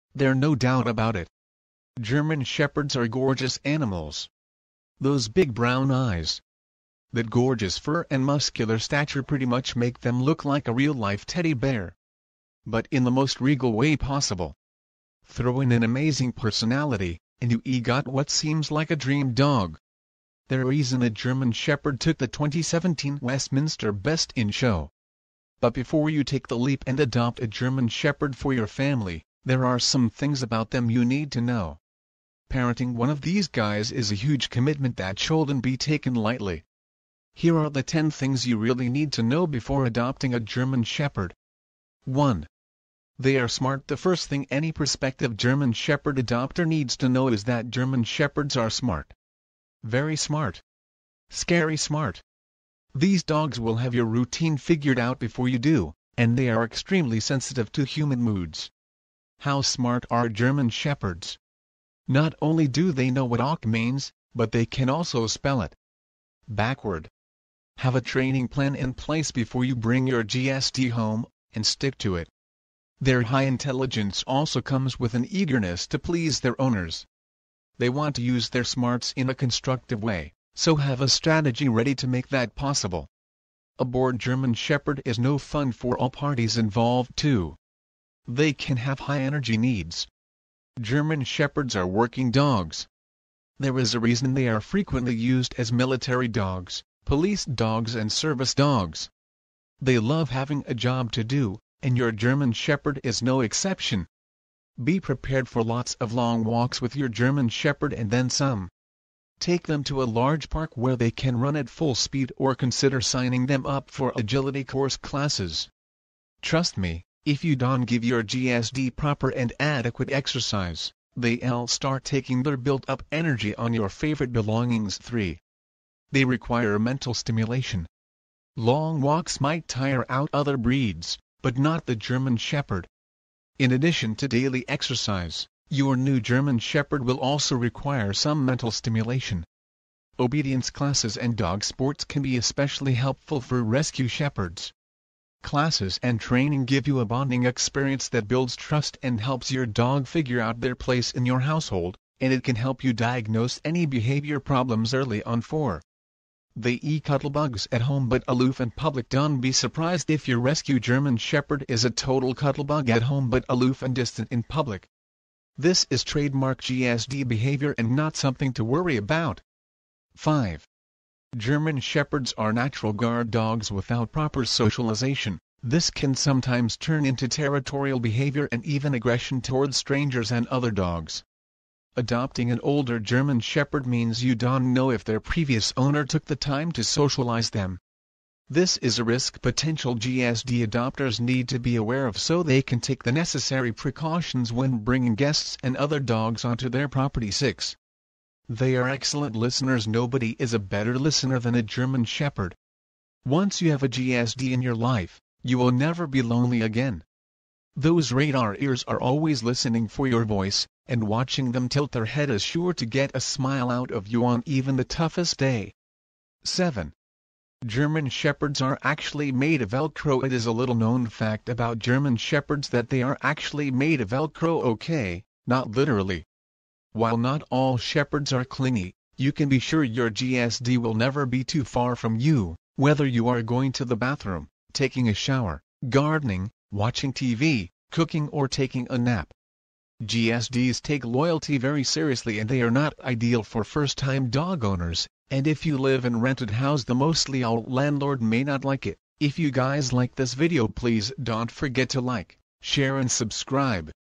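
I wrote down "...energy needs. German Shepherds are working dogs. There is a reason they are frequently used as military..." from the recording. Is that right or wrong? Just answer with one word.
right.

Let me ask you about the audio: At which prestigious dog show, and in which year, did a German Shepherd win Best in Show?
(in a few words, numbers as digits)
2017 Westminster.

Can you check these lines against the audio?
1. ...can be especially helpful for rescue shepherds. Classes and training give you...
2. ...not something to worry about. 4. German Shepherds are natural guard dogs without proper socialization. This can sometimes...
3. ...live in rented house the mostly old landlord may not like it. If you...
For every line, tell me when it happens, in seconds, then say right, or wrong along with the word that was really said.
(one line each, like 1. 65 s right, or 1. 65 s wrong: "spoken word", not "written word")
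1. 142 s right
2. 167 s wrong: "5", not "4"
3. 245 s right.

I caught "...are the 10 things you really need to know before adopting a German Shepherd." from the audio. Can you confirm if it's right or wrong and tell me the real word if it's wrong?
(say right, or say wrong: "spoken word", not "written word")
right.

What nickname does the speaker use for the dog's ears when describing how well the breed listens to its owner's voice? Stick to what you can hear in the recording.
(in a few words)
radar ears.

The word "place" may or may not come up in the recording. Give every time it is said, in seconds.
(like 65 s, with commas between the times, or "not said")
68 s, 150 s.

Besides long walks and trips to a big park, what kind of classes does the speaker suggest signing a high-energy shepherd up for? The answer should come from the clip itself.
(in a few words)
agility course classes.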